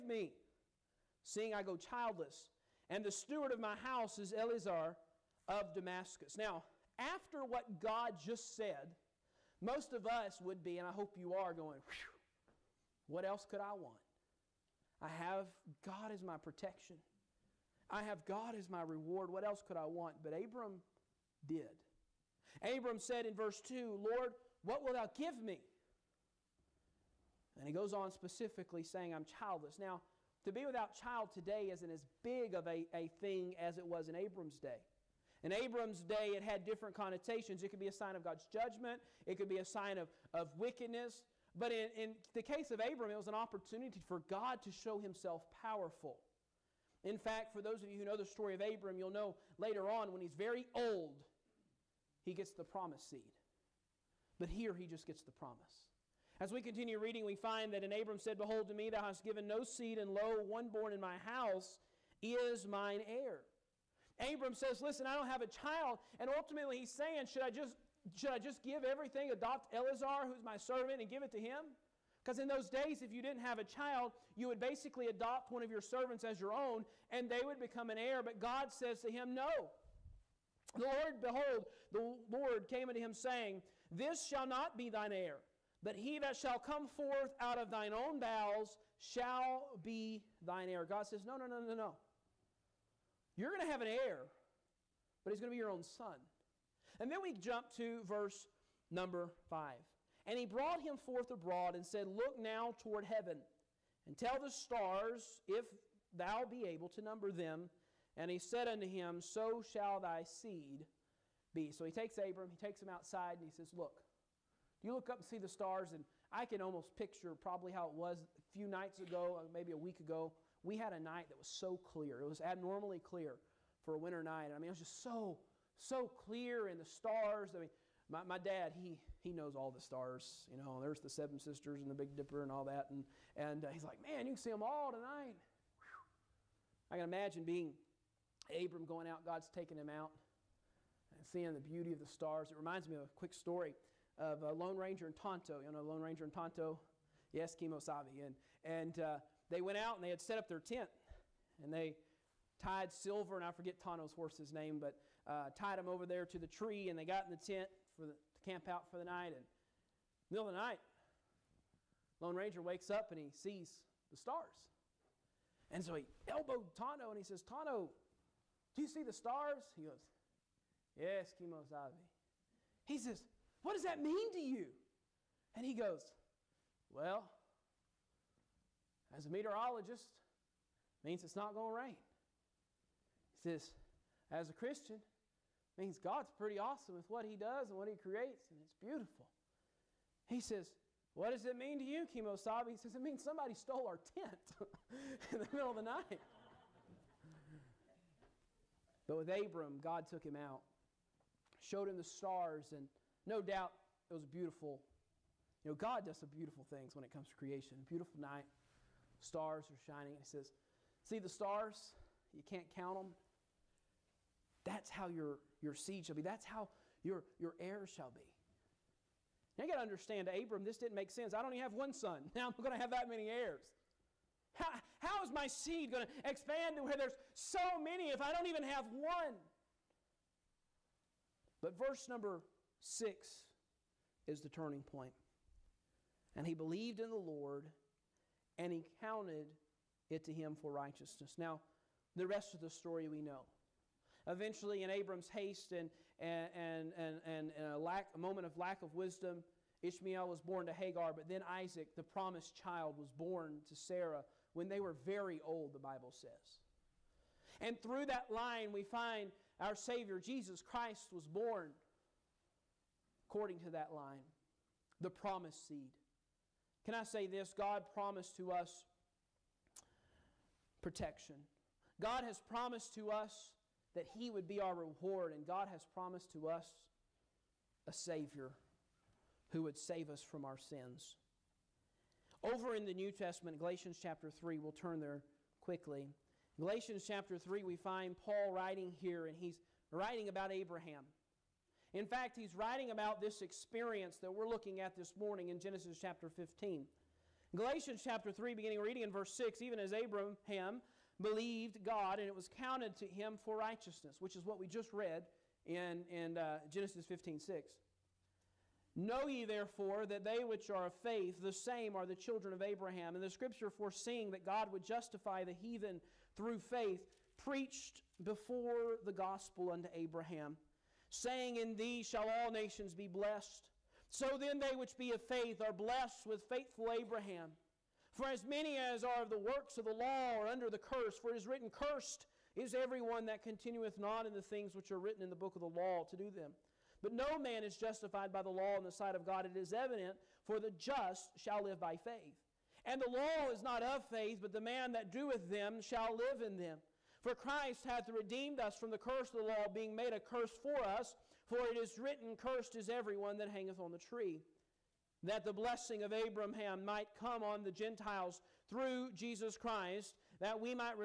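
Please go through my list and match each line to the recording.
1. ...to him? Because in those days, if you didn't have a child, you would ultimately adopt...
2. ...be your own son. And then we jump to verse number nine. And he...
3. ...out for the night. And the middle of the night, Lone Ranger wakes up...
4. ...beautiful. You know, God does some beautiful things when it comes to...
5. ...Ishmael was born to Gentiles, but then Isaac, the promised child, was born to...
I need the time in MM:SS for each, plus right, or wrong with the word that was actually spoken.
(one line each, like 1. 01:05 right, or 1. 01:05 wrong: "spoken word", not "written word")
1. 01:11 wrong: "basically", not "ultimately"
2. 01:35 wrong: "five", not "nine"
3. 02:38 right
4. 03:24 right
5. 04:09 wrong: "Hagar", not "Gentiles".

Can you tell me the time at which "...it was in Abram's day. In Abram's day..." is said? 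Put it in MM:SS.
00:33.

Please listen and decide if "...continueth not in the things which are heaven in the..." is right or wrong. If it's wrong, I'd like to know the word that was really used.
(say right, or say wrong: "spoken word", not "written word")
wrong: "written", not "heaven".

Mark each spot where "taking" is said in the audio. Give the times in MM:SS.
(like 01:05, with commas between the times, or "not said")
02:19.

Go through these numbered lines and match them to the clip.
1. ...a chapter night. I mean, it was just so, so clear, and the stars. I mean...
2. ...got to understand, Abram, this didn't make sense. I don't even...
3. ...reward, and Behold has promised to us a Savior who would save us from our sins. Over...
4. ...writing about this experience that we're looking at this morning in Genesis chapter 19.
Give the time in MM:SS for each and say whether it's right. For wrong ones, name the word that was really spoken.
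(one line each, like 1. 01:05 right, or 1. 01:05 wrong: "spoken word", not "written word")
1. 02:03 wrong: "winter", not "chapter"
2. 03:39 right
3. 04:34 wrong: "God", not "Behold"
4. 04:52 wrong: "15", not "19".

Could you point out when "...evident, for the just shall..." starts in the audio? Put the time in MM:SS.
05:39.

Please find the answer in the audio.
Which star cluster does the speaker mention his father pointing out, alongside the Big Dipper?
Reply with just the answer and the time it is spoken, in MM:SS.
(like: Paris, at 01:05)
Seven Sisters, at 02:11.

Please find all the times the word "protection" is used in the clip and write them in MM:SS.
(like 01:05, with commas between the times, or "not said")
00:16, 04:30.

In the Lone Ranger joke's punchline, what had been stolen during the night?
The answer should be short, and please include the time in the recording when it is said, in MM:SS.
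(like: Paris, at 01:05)
Their tent, at 03:13.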